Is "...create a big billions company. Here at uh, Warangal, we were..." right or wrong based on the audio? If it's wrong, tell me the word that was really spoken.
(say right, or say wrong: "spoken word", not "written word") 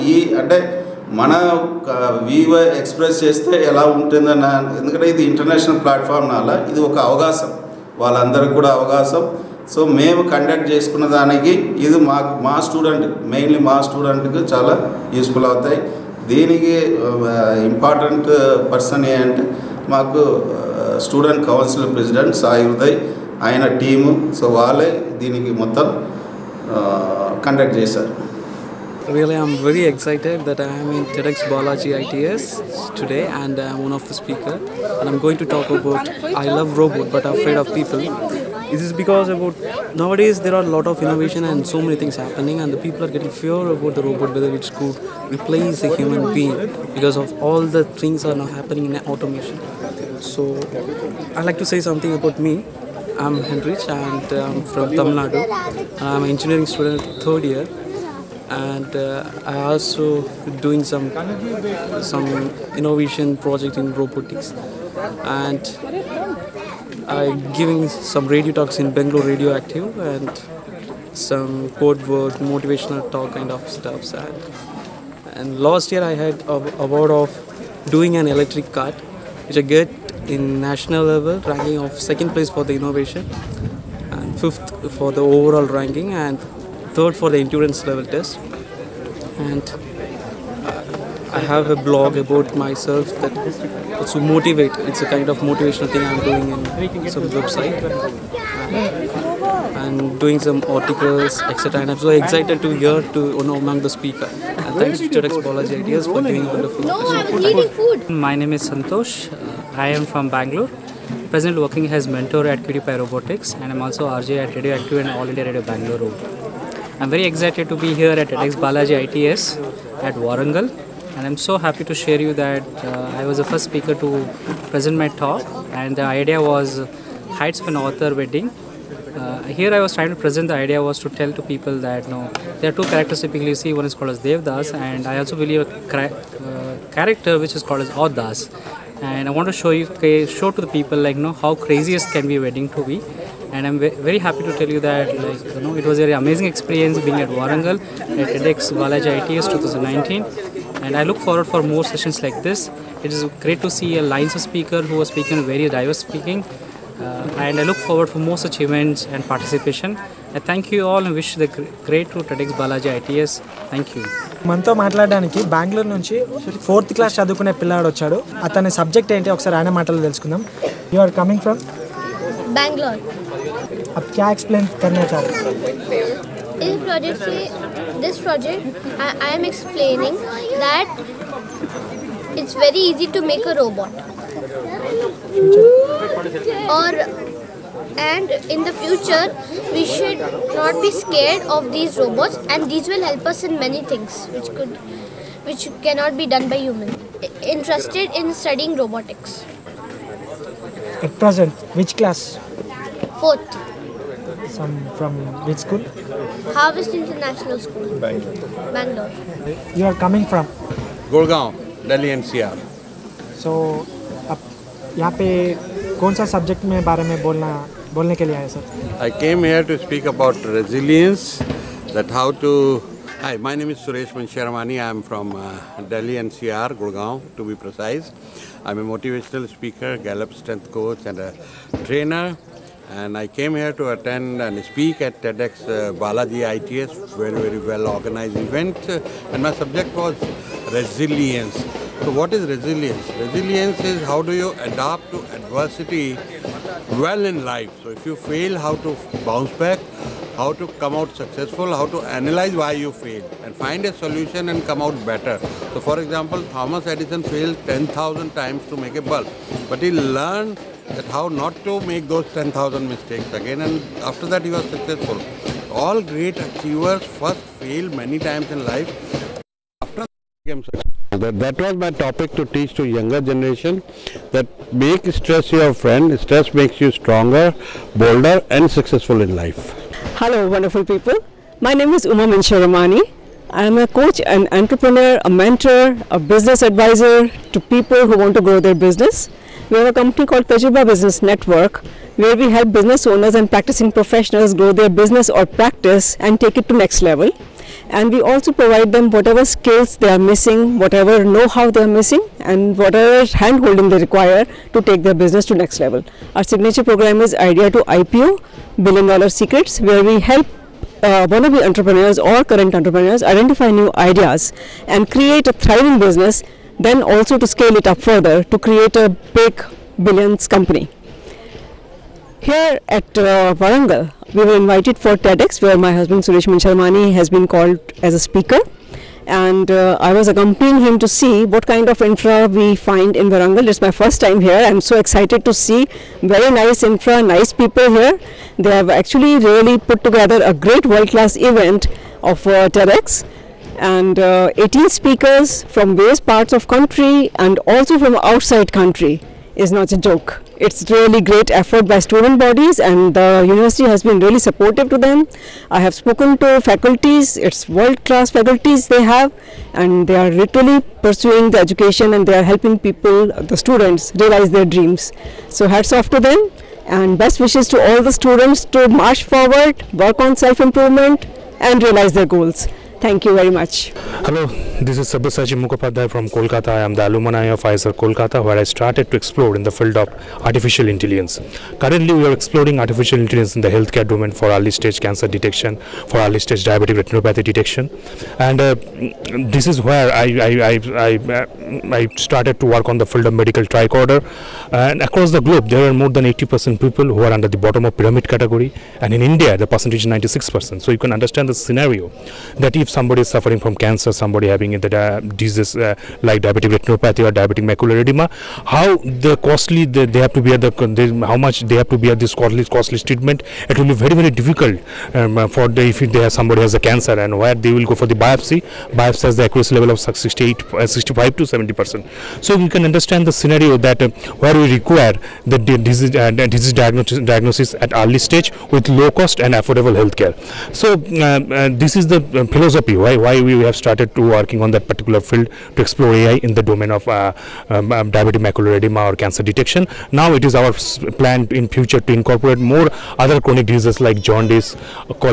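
right.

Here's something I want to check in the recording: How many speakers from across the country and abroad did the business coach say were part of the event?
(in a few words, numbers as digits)
18.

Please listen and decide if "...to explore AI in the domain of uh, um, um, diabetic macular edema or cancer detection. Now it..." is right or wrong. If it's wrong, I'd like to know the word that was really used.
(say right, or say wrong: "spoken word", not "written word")
right.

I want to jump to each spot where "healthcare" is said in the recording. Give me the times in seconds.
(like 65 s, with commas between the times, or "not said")
383 s, 429 s.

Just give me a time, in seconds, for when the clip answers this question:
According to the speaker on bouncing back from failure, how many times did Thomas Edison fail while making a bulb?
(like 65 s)
257 s.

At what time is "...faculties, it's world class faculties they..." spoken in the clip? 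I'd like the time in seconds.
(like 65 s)
356 s.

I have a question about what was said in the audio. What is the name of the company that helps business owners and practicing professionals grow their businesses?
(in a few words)
Tajriba Business Network.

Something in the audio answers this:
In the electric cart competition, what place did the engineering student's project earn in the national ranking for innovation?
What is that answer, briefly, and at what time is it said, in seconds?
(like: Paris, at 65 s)
Second place, at 81 s.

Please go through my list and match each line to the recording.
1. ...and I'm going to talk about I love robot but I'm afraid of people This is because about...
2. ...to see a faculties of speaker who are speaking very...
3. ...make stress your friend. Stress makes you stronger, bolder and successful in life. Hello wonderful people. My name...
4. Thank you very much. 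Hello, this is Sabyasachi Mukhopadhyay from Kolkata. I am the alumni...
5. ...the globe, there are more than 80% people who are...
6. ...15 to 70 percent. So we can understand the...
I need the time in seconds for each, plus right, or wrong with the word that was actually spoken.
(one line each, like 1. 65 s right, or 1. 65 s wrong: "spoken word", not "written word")
1. 34 s right
2. 153 s wrong: "lines", not "faculties"
3. 274 s right
4. 372 s right
5. 395 s right
6. 420 s wrong: "65", not "15".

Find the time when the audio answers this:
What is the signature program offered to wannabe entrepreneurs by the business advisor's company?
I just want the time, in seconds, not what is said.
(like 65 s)
307 s.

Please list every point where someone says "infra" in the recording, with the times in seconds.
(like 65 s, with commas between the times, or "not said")
331 s, 336 s.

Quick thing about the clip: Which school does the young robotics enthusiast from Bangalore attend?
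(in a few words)
Harvest International School.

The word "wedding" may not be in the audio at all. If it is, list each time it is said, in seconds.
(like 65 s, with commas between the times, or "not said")
128 s, 142 s.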